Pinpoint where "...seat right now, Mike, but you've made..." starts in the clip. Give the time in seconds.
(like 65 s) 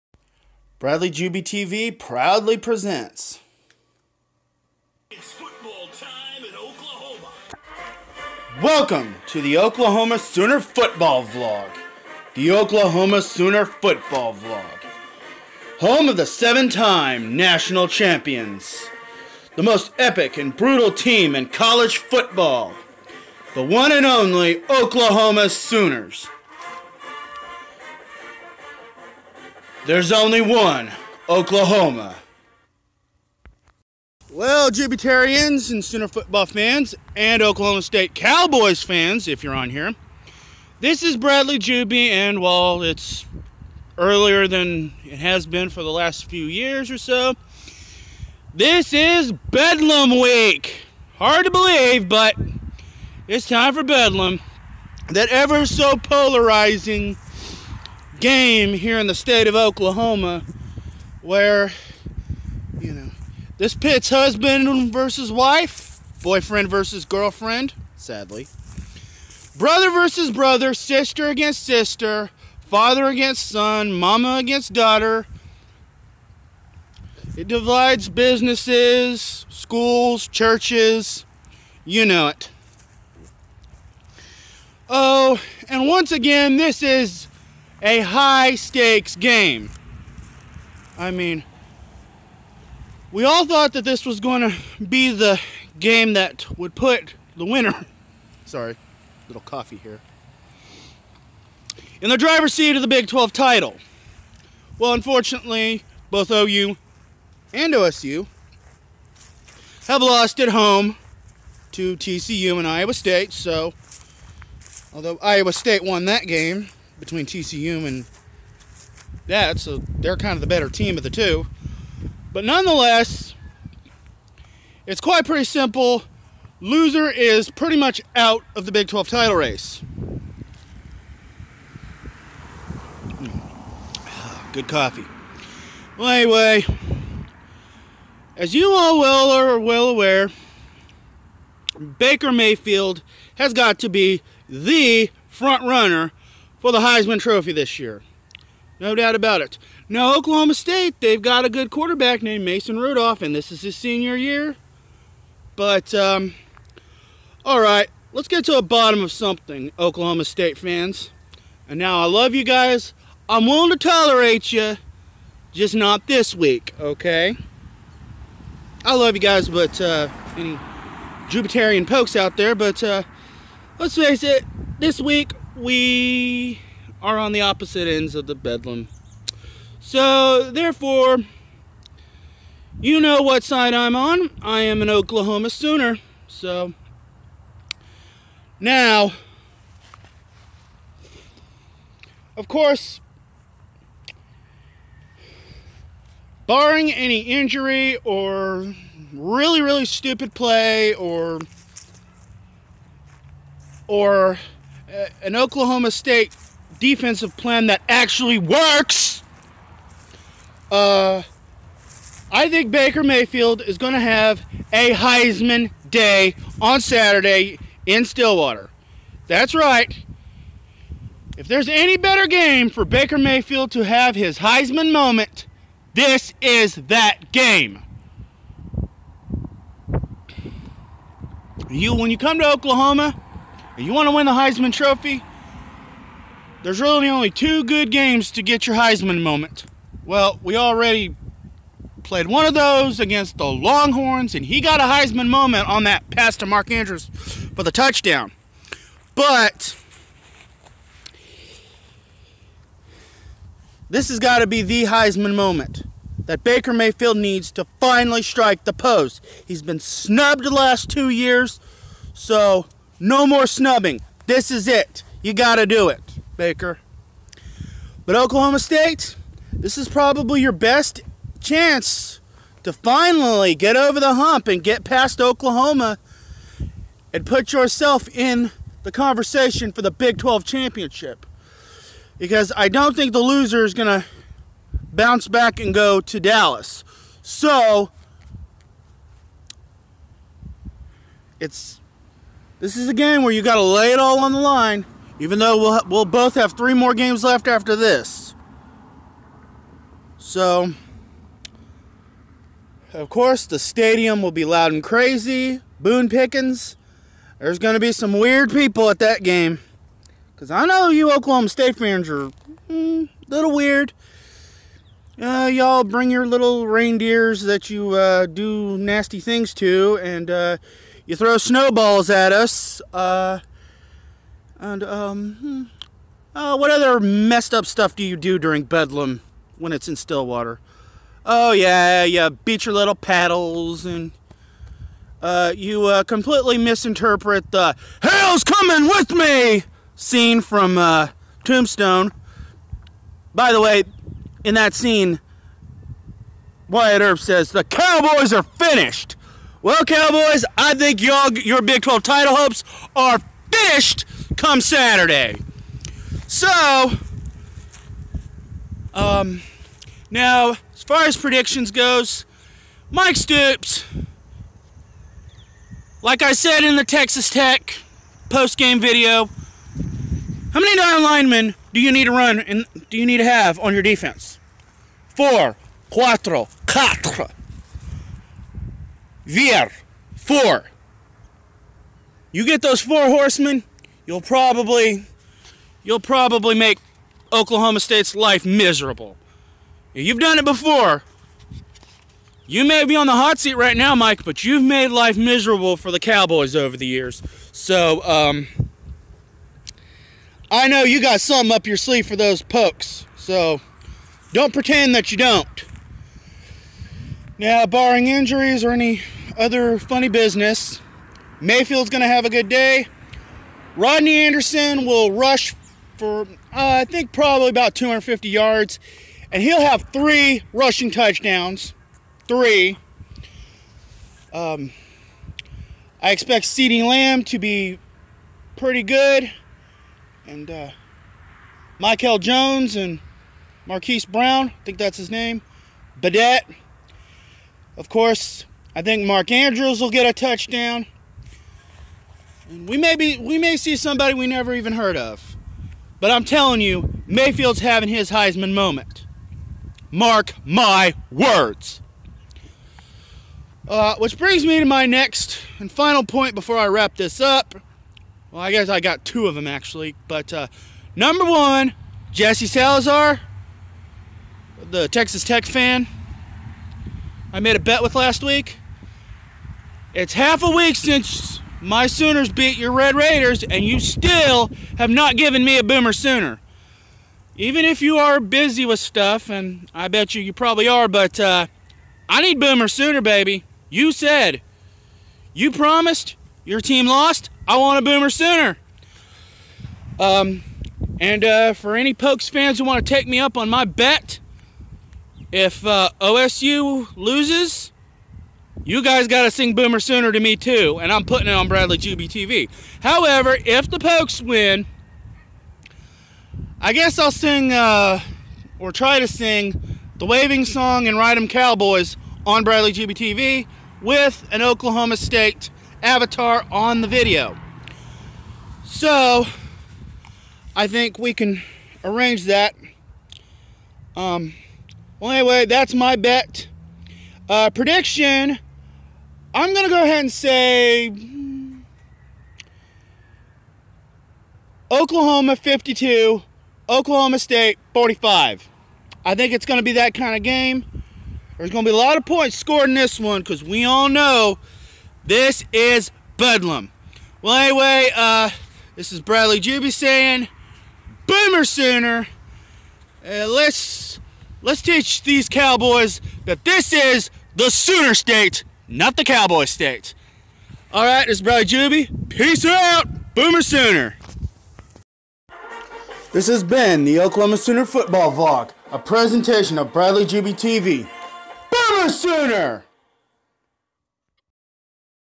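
393 s.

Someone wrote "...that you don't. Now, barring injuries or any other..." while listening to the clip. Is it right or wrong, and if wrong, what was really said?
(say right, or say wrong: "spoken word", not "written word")
right.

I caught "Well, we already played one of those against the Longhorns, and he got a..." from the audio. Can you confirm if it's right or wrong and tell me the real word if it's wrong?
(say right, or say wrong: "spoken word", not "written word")
right.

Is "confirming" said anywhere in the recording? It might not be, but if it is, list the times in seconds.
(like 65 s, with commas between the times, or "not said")
not said.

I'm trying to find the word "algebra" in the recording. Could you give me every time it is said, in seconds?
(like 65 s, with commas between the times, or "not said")
not said.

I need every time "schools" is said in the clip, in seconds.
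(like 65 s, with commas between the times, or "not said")
79 s.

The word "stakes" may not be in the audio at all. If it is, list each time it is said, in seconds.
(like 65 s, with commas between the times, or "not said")
88 s.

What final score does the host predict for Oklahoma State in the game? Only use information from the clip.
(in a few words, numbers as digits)
45.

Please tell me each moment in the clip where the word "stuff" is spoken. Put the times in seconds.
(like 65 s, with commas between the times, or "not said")
327 s, 478 s.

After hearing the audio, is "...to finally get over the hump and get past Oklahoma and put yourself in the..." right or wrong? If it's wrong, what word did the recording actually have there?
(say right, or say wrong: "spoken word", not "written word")
right.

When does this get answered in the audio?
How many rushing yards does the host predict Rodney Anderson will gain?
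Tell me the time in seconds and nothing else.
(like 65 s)
417 s.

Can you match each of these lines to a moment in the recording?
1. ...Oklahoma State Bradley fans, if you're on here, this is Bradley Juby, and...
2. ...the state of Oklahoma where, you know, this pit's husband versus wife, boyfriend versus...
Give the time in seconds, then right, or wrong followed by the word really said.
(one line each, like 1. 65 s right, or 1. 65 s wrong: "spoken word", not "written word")
1. 37 s wrong: "Cowboys", not "Bradley"
2. 59 s right.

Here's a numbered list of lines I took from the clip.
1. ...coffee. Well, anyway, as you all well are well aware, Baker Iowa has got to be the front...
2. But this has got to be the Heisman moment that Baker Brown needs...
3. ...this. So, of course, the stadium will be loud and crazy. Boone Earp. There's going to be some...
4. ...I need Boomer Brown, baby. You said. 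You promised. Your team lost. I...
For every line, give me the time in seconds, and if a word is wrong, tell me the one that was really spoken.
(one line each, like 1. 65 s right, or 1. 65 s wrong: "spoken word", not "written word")
1. 134 s wrong: "Mayfield", not "Iowa"
2. 249 s wrong: "Mayfield", not "Brown"
3. 297 s wrong: "Pickens", not "Earp"
4. 482 s wrong: "Sooner", not "Brown".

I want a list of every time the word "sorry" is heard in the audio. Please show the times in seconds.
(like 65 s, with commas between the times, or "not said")
98 s.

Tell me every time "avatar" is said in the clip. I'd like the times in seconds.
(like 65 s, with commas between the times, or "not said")
515 s.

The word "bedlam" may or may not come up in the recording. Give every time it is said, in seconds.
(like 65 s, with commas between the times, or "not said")
49 s, 53 s, 178 s, 328 s, 546 s.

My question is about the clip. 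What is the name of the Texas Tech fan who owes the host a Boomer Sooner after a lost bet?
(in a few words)
Jesse Salazar.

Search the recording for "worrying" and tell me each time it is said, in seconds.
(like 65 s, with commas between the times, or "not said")
not said.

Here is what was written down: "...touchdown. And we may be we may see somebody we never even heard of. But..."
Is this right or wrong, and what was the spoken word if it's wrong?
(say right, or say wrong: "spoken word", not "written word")
right.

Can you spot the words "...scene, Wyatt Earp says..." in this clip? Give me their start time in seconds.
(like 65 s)
344 s.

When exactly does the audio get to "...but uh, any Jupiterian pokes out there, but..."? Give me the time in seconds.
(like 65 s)
169 s.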